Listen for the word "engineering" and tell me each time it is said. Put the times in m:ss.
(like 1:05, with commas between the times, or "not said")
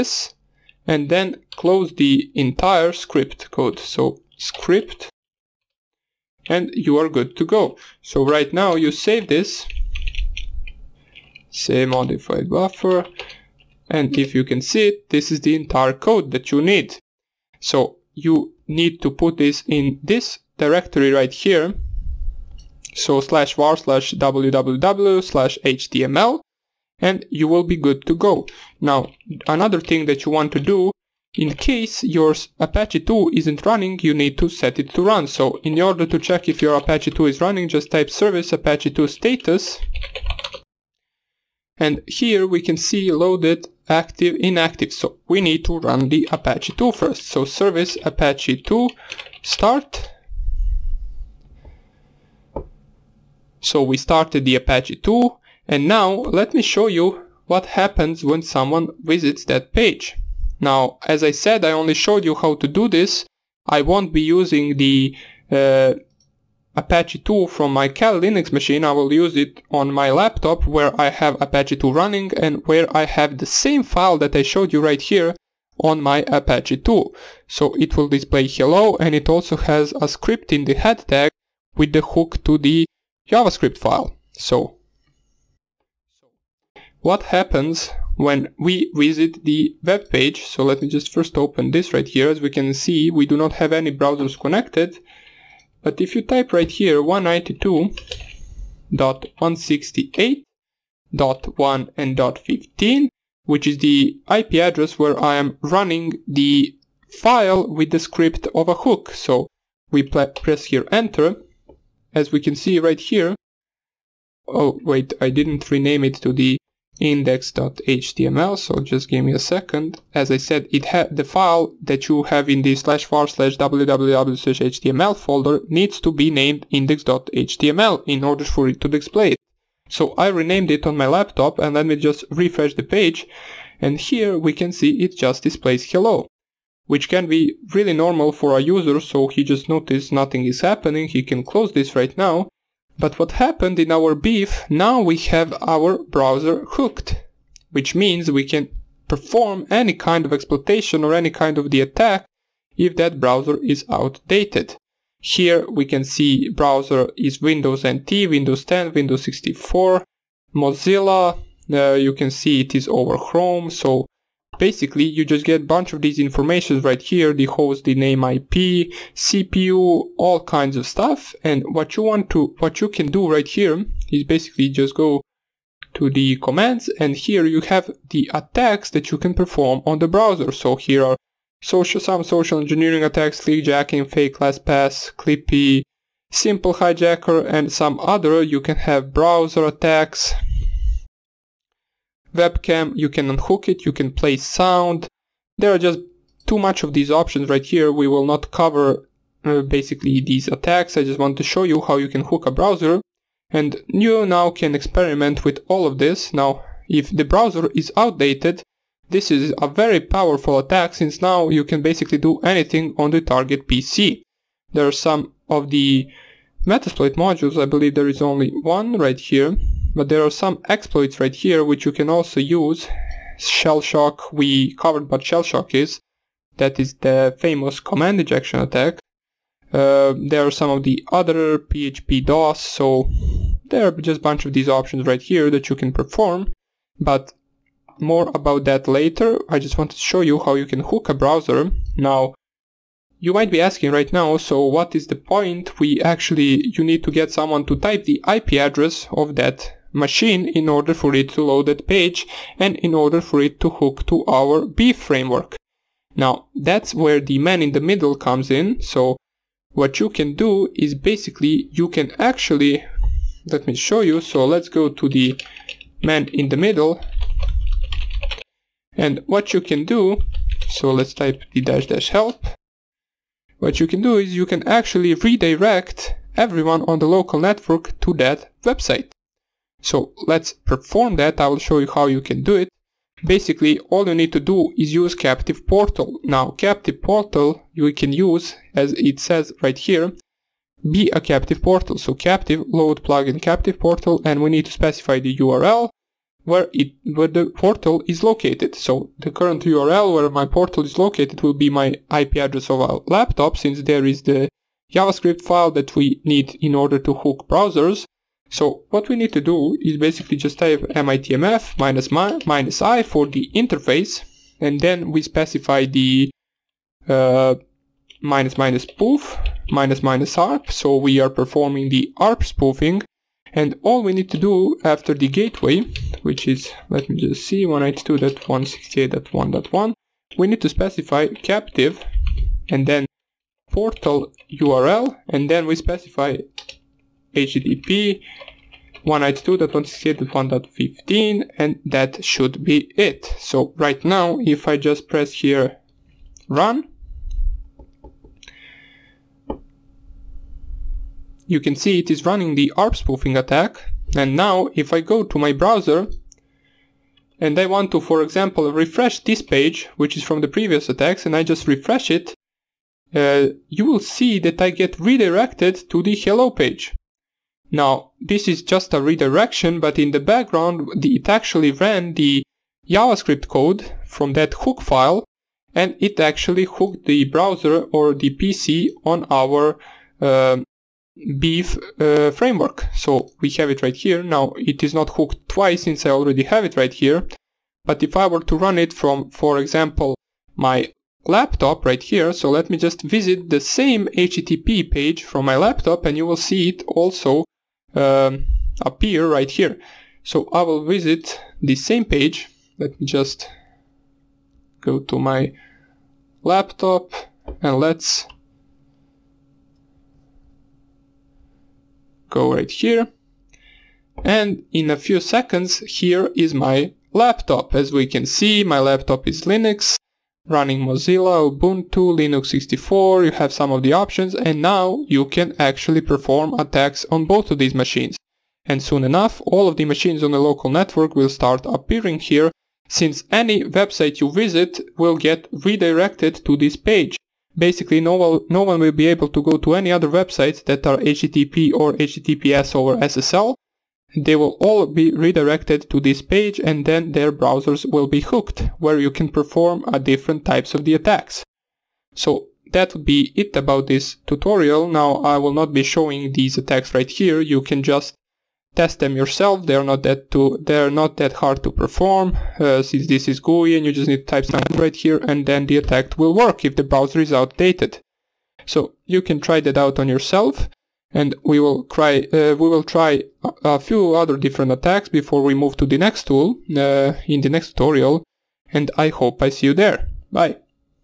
3:02.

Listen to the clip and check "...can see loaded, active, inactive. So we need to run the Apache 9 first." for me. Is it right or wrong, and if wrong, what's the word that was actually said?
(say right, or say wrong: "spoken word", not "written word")
wrong: "2", not "9".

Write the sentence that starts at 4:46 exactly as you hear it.
Now captive portal you can use as it says right here be a captive portal.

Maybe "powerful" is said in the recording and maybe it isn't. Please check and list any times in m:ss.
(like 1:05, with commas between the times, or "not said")
3:29.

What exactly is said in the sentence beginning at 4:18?
So what you can do is basically you can actually, let me show you.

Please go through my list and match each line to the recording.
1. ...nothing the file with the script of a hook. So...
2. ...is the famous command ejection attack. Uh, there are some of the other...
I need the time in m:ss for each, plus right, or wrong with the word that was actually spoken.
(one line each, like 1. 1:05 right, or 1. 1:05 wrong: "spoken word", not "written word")
1. 1:45 wrong: "running", not "nothing"
2. 3:46 right.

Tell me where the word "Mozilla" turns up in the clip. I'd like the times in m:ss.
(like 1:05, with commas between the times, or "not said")
2:40, 7:00.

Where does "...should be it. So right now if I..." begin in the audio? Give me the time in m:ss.
5:42.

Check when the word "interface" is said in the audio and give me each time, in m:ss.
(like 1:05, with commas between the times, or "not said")
5:13.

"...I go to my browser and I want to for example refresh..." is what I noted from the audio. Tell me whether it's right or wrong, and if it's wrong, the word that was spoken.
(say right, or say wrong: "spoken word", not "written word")
right.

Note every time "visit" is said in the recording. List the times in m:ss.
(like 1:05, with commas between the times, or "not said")
0:58, 1:29, 6:33, 6:40, 7:14.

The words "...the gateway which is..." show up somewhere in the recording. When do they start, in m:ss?
5:25.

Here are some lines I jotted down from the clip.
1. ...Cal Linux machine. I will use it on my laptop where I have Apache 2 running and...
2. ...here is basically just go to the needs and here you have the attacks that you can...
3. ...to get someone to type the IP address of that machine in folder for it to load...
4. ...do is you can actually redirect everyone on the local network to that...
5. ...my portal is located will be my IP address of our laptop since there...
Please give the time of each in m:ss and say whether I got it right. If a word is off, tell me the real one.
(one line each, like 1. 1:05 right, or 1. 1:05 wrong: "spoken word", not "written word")
1. 1:07 right
2. 2:53 wrong: "commands", not "needs"
3. 4:07 wrong: "order", not "folder"
4. 4:34 right
5. 5:00 right.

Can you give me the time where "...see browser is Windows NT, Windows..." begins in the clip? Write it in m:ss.
2:36.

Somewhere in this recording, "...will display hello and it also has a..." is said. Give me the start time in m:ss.
1:17.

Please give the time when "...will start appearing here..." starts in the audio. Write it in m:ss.
7:11.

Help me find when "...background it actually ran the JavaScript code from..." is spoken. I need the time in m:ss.
6:10.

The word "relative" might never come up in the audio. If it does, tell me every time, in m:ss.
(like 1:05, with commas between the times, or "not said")
not said.